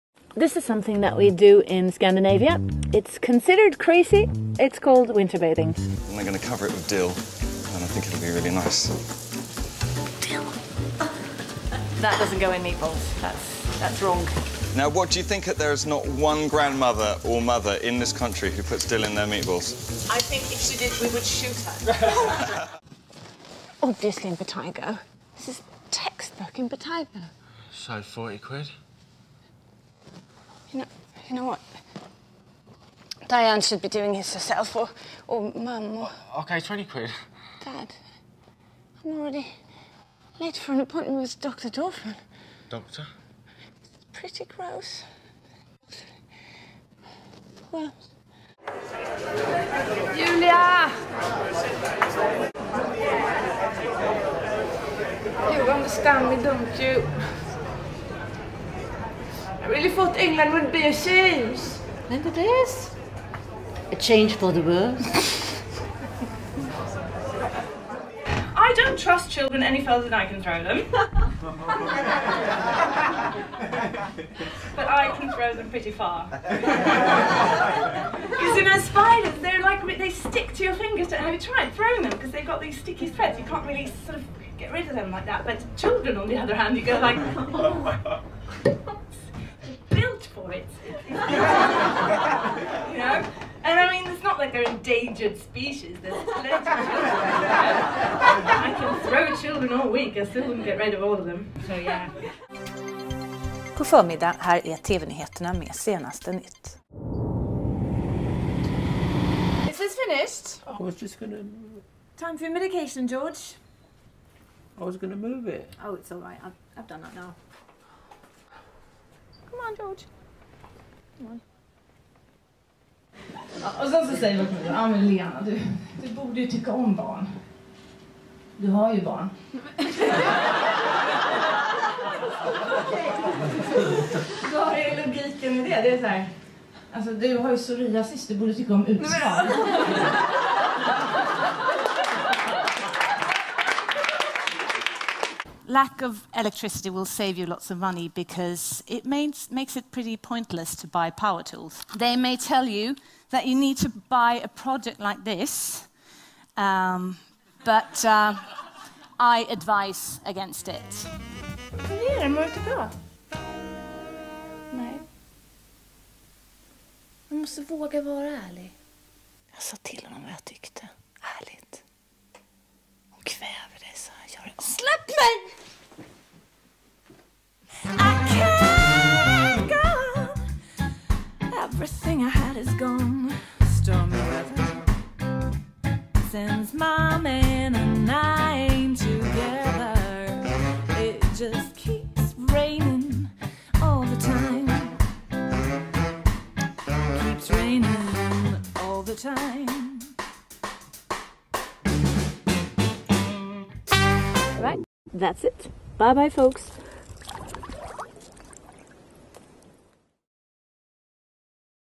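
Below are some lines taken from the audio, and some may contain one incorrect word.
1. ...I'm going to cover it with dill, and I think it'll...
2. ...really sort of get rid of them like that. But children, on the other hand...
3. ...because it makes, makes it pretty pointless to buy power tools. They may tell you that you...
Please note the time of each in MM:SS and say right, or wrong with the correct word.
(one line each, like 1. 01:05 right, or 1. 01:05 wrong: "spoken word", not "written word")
1. 00:06 right
2. 01:23 right
3. 02:28 right.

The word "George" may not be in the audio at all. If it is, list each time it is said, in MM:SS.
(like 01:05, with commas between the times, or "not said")
01:53, 01:59.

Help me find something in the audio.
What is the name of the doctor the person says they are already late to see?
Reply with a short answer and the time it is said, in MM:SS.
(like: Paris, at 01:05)
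Dr. Dorfman, at 00:41.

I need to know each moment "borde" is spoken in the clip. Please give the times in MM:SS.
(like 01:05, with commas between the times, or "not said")
02:06, 02:18.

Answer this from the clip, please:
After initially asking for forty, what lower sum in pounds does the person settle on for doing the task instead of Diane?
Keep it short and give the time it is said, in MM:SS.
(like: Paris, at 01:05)
20 quid, at 00:36.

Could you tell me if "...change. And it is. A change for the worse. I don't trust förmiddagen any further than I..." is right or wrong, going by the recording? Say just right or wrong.
wrong.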